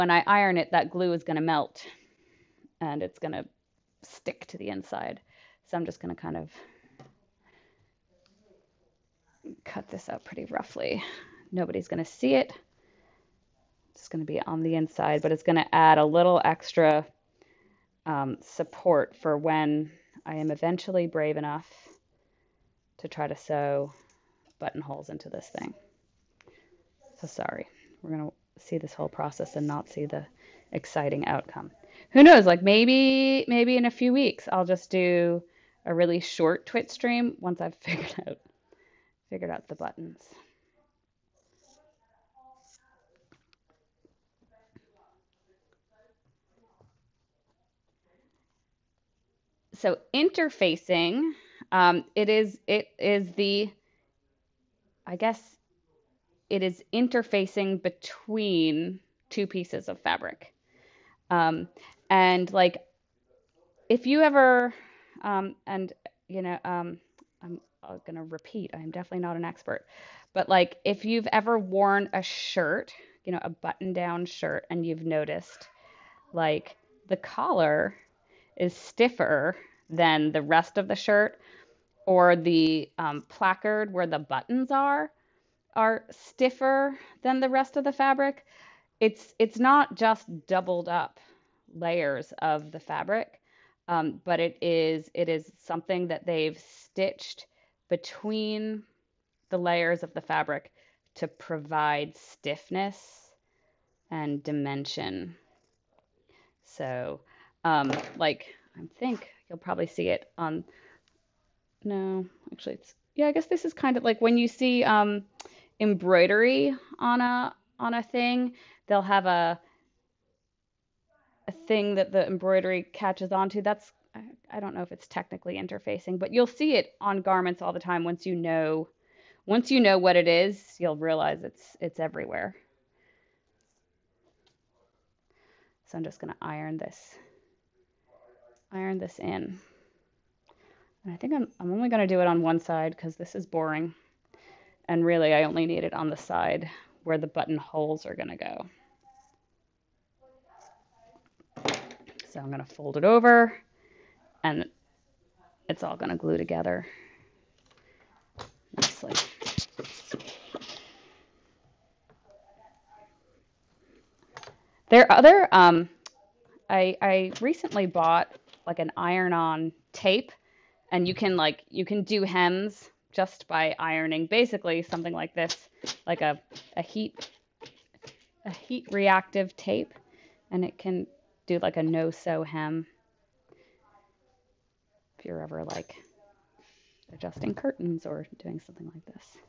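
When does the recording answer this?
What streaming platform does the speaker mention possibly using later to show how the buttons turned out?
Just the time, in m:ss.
0:36.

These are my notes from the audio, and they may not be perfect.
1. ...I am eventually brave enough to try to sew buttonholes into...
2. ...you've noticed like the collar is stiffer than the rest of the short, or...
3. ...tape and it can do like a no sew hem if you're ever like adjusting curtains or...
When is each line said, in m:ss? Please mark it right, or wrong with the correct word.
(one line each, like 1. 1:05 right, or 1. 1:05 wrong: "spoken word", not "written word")
1. 0:20 right
2. 1:14 wrong: "shirt", not "short"
3. 2:59 right.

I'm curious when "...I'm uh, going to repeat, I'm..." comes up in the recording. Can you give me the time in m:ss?
1:07.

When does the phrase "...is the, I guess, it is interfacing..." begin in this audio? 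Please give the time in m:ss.
0:52.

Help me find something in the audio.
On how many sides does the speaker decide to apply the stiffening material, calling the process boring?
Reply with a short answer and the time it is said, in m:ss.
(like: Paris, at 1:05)
1, at 2:22.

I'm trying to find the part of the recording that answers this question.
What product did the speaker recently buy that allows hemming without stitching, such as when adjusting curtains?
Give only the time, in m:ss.
2:48.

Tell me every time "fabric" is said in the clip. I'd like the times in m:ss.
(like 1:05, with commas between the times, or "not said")
0:59, 1:27, 1:32, 1:40.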